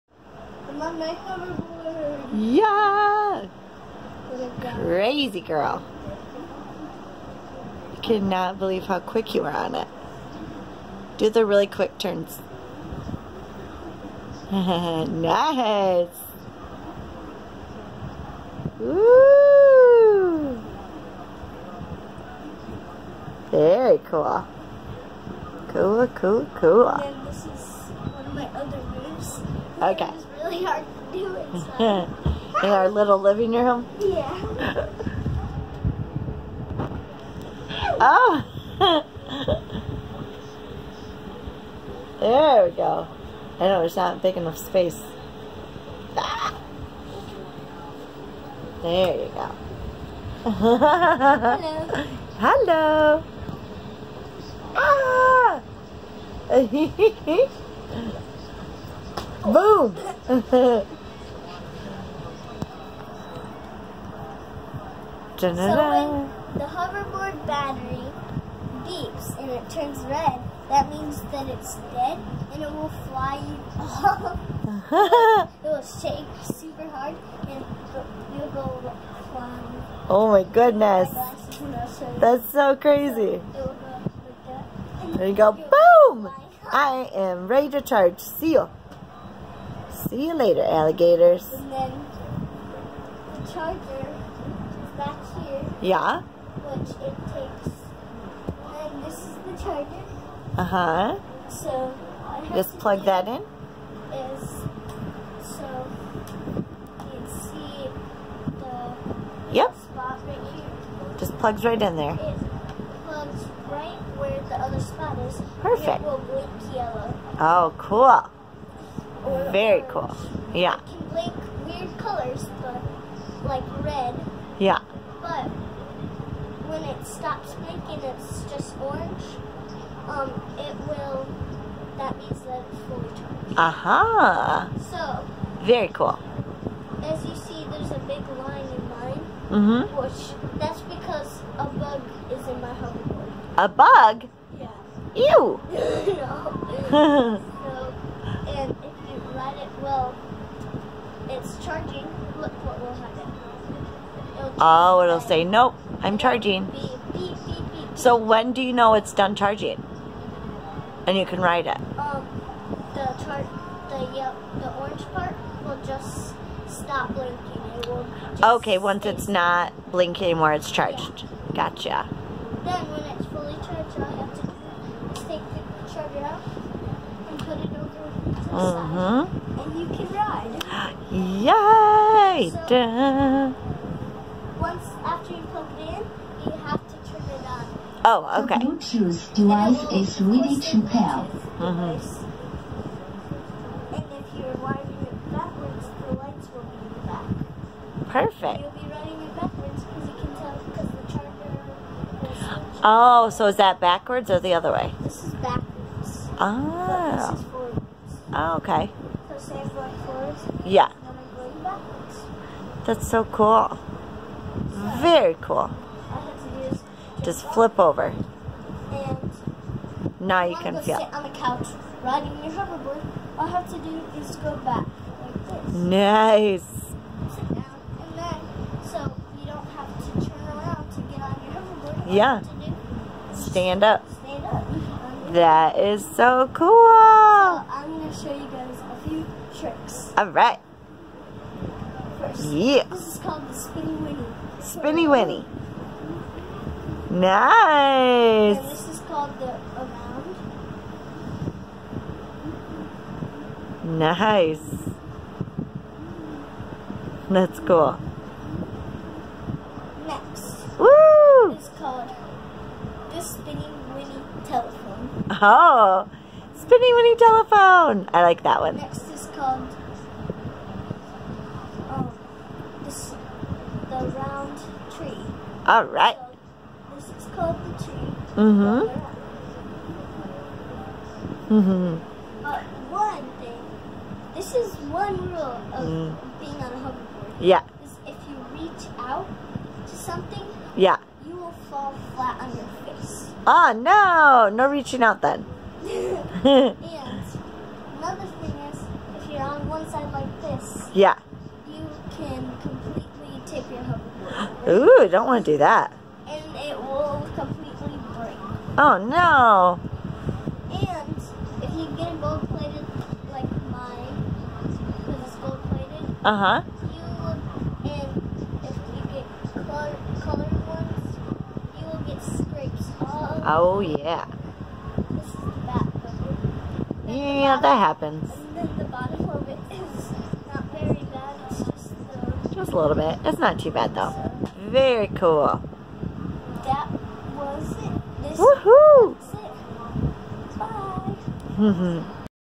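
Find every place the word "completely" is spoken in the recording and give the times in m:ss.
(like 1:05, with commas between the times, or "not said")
5:02, 5:07.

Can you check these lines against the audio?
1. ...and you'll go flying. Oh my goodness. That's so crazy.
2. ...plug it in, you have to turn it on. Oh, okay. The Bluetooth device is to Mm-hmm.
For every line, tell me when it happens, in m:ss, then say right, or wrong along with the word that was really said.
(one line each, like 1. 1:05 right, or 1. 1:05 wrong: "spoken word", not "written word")
1. 1:17 right
2. 3:05 right.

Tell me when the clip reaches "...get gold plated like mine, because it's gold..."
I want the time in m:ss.
5:11.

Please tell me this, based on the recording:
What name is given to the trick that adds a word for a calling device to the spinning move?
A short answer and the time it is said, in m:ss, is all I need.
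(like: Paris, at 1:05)
Spinny Winnie Telephone, at 4:23.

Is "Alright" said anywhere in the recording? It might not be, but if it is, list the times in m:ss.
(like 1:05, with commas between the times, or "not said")
4:00.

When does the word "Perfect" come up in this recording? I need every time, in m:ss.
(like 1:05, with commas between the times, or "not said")
1:55, 3:18.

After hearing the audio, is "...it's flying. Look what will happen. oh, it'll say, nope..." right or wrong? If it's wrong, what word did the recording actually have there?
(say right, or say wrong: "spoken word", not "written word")
wrong: "charging", not "flying".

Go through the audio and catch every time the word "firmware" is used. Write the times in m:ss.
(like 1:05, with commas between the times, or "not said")
not said.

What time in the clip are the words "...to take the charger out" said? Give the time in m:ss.
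2:55.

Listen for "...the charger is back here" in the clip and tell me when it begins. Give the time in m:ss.
1:33.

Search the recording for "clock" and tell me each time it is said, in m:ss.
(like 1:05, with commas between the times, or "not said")
not said.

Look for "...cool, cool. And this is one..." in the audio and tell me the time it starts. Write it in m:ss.
0:26.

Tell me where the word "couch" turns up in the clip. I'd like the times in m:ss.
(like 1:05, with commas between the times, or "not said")
3:41.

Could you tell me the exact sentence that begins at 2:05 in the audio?
But when it stops blinking, it's just orange.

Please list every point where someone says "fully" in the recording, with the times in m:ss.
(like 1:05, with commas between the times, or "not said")
2:12, 2:53.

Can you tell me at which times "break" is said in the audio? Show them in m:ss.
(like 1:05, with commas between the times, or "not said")
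5:08.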